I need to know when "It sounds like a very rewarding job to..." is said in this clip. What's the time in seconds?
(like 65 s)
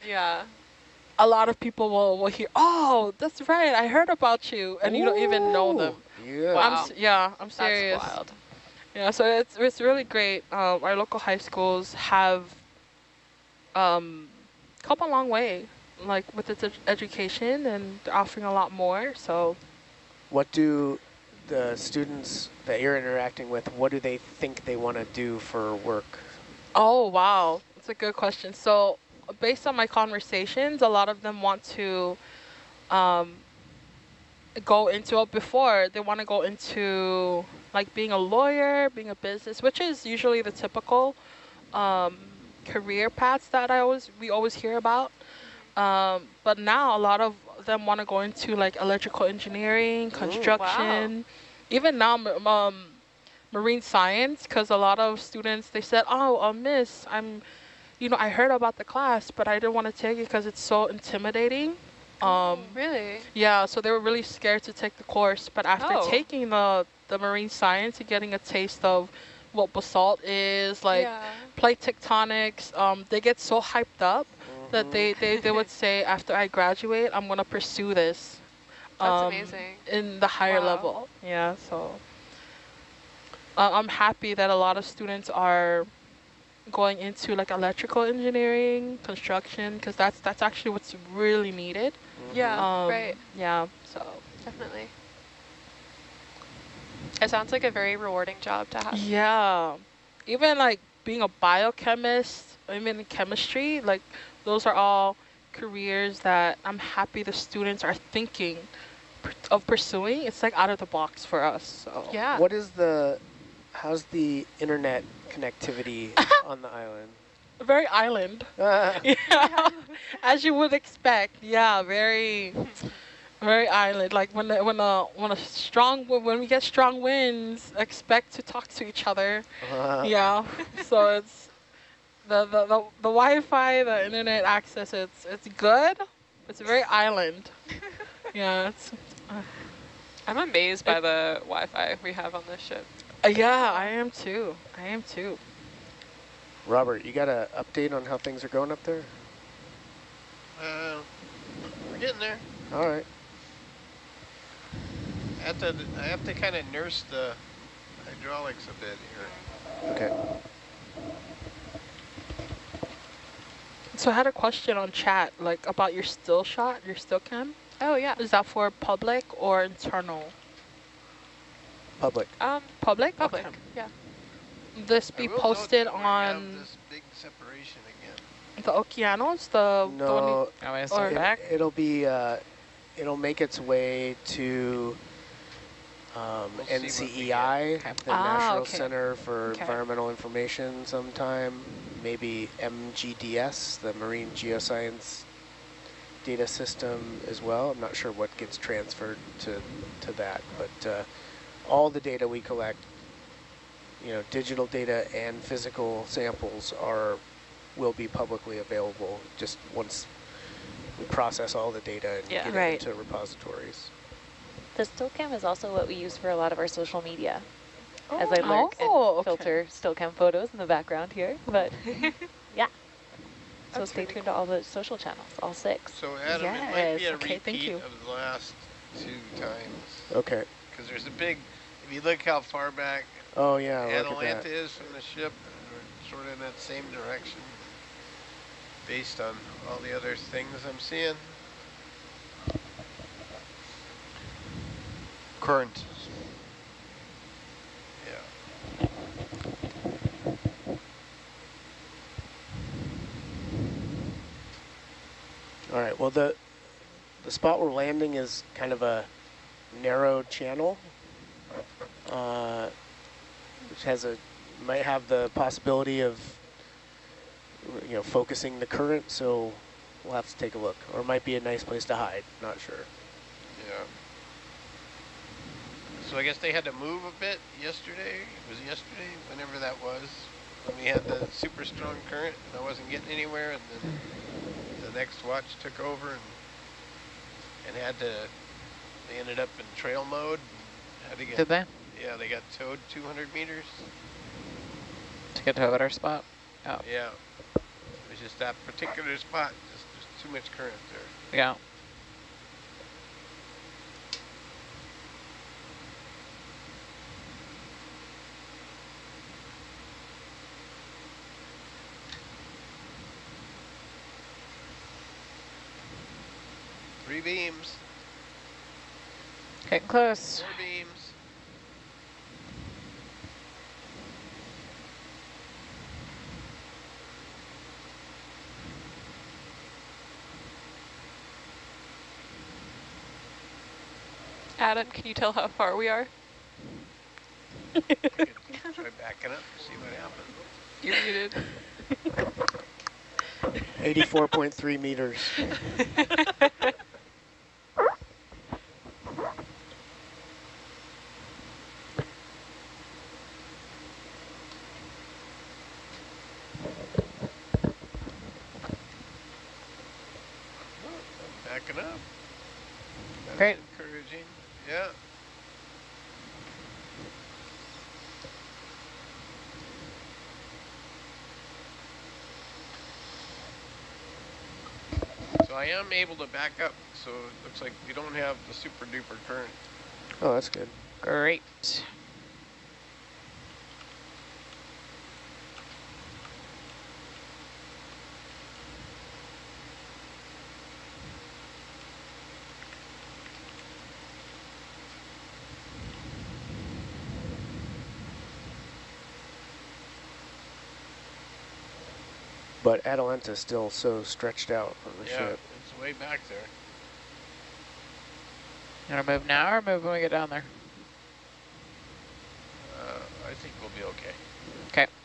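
97 s.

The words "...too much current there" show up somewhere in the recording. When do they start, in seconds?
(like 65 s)
300 s.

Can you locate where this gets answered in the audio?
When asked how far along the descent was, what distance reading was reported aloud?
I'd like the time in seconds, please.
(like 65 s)
344 s.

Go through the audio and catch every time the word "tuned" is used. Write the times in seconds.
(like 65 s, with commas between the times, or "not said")
224 s.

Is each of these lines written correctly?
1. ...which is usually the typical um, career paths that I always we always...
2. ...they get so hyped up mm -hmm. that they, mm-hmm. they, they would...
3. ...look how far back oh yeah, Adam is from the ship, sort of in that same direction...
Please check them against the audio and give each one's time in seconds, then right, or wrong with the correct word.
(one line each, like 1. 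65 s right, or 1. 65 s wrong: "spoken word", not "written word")
1. 39 s right
2. 73 s right
3. 232 s wrong: "Atalanta", not "Adam".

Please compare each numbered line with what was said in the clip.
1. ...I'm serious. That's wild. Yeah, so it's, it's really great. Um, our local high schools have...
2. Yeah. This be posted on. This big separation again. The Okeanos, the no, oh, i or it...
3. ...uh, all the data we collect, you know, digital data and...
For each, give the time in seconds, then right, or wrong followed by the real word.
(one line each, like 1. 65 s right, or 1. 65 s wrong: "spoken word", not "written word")
1. 7 s right
2. 173 s right
3. 200 s right.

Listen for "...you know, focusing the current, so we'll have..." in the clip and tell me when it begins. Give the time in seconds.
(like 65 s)
267 s.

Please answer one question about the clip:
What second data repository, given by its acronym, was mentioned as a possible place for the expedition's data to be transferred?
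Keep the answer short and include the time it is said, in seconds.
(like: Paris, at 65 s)
MGDS, at 192 s.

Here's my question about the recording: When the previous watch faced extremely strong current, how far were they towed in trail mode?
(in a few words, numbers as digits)
200 meters.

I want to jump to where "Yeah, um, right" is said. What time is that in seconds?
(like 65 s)
92 s.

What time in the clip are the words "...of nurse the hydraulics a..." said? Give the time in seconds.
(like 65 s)
156 s.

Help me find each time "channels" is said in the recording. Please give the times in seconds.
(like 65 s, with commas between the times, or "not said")
224 s, 260 s.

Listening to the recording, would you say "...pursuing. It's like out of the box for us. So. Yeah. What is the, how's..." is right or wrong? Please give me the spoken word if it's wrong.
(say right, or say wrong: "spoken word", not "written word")
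right.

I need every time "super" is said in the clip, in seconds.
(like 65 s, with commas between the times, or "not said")
281 s, 378 s.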